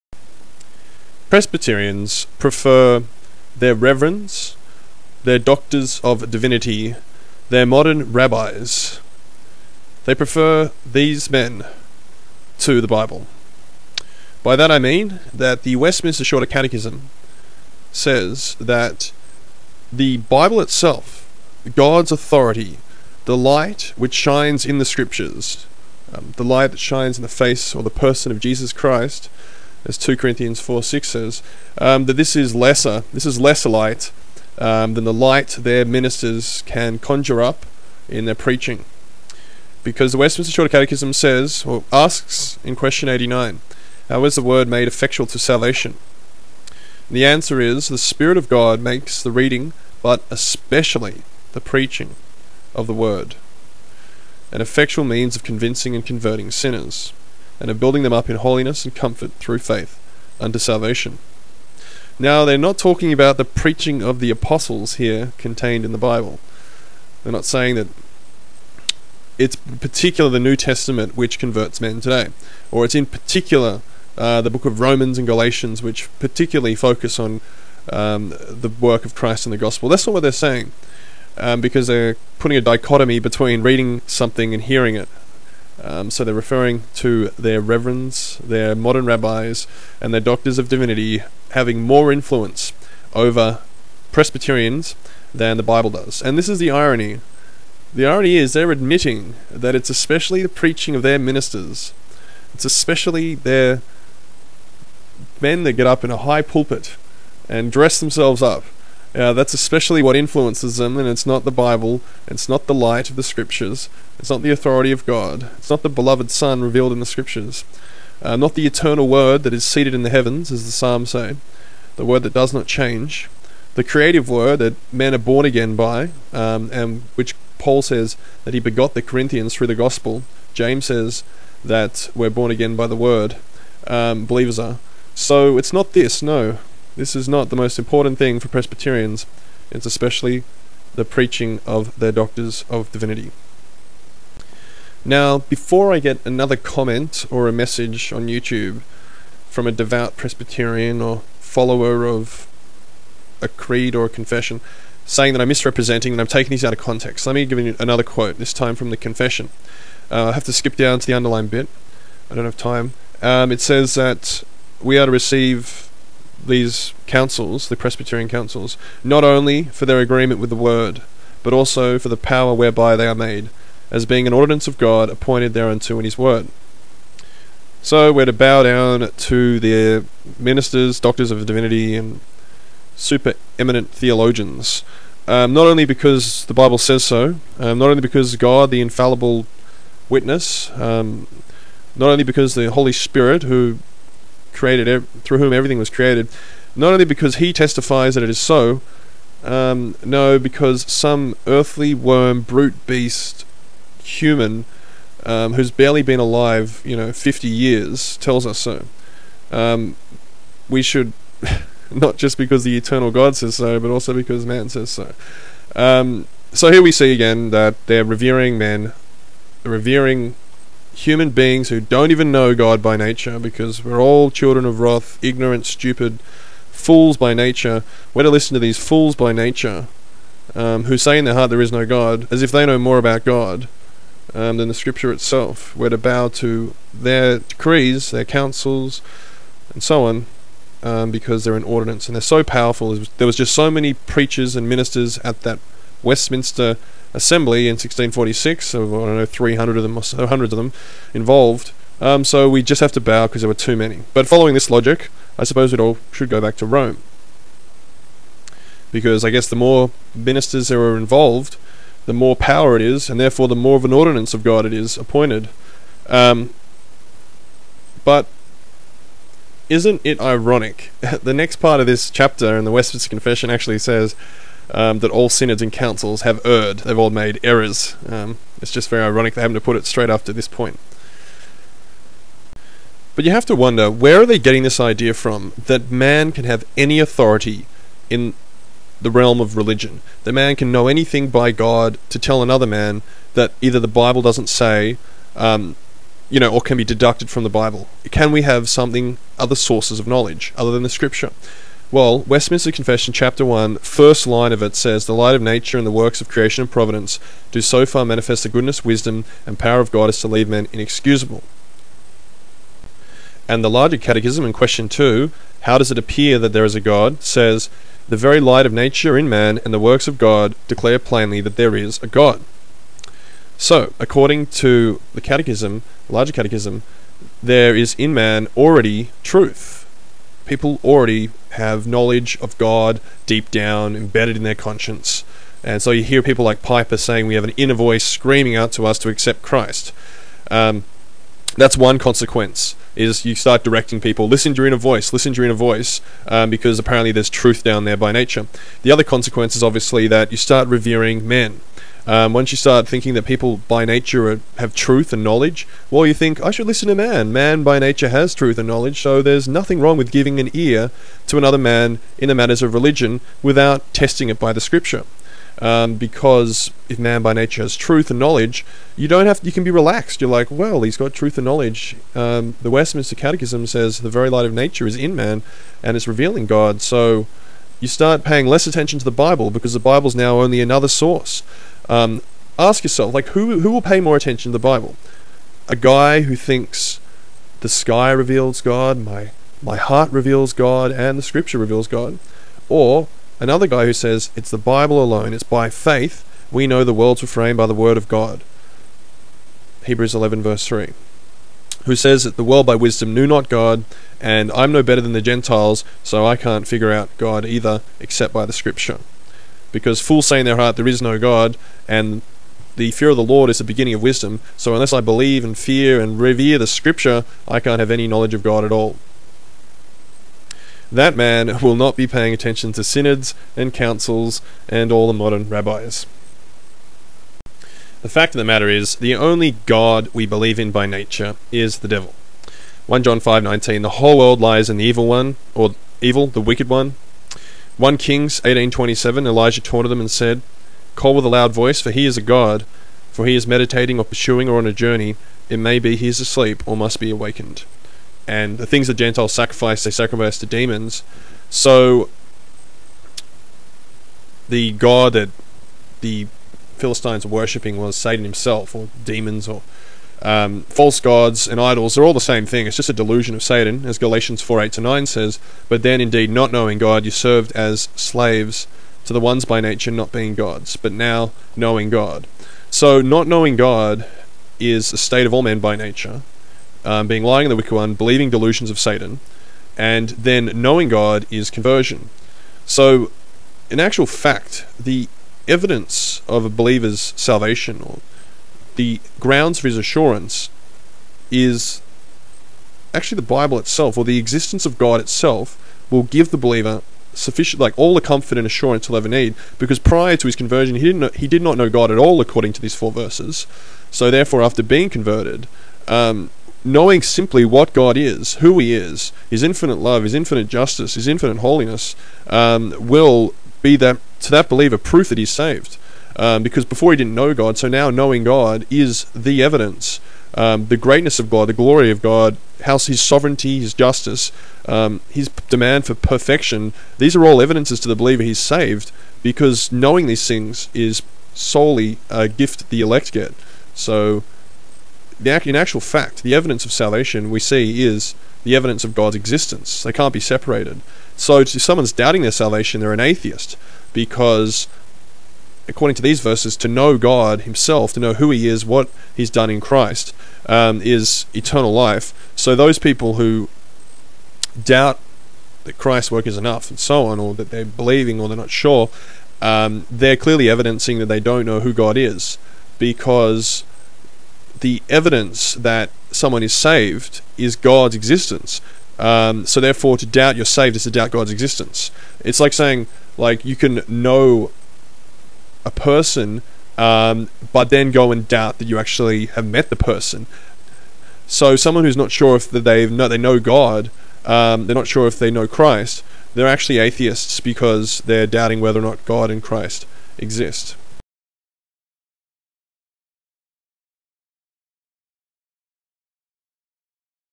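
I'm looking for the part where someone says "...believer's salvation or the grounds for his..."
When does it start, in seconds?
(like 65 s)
486 s.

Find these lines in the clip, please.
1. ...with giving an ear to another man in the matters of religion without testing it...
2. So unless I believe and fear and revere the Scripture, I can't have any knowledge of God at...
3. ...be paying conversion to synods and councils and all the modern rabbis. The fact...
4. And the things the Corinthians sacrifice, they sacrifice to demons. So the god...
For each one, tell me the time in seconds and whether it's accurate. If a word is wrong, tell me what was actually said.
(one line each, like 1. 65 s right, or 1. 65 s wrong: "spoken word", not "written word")
1. 359 s right
2. 414 s right
3. 421 s wrong: "attention", not "conversion"
4. 448 s wrong: "Gentiles", not "Corinthians".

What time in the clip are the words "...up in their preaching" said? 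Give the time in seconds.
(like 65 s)
37 s.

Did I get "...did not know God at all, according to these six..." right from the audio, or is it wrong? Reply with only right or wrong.
wrong.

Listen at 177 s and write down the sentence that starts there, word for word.
So we're to bow down to their ministers, doctors of divinity, and super eminent theologians.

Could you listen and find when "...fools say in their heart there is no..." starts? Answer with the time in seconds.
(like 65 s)
410 s.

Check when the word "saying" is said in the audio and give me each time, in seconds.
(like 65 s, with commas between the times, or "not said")
67 s, 80 s, 155 s, 336 s, 572 s.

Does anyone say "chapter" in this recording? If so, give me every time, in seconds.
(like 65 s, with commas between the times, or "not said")
272 s, 303 s.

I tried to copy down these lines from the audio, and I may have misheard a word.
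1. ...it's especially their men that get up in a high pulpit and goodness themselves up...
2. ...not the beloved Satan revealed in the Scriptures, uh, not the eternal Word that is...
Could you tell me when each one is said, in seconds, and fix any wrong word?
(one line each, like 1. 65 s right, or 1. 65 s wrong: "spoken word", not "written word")
1. 102 s wrong: "dress", not "goodness"
2. 115 s wrong: "Son", not "Satan".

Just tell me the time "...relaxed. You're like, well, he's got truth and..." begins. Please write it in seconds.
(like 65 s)
369 s.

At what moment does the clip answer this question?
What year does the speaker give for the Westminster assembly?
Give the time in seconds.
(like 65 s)
247 s.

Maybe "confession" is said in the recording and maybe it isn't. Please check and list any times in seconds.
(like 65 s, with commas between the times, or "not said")
154 s, 158 s, 273 s, 302 s.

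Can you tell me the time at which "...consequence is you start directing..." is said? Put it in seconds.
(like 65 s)
341 s.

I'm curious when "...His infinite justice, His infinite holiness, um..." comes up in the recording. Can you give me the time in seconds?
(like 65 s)
510 s.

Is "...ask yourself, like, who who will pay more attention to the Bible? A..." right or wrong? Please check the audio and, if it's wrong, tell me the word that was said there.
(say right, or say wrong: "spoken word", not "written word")
right.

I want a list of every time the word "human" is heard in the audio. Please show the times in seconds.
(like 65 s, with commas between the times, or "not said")
204 s, 220 s.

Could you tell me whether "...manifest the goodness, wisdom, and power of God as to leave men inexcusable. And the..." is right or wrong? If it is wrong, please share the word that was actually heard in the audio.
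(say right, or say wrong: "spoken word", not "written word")
right.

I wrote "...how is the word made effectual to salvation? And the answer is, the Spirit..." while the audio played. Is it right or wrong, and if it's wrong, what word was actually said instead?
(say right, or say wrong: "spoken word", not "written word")
right.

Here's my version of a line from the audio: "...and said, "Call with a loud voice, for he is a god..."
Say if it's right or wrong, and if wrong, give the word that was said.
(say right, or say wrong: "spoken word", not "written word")
right.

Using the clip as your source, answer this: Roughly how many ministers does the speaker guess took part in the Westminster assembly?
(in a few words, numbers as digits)
300.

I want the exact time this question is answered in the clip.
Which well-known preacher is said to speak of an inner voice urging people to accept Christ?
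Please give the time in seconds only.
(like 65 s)
336 s.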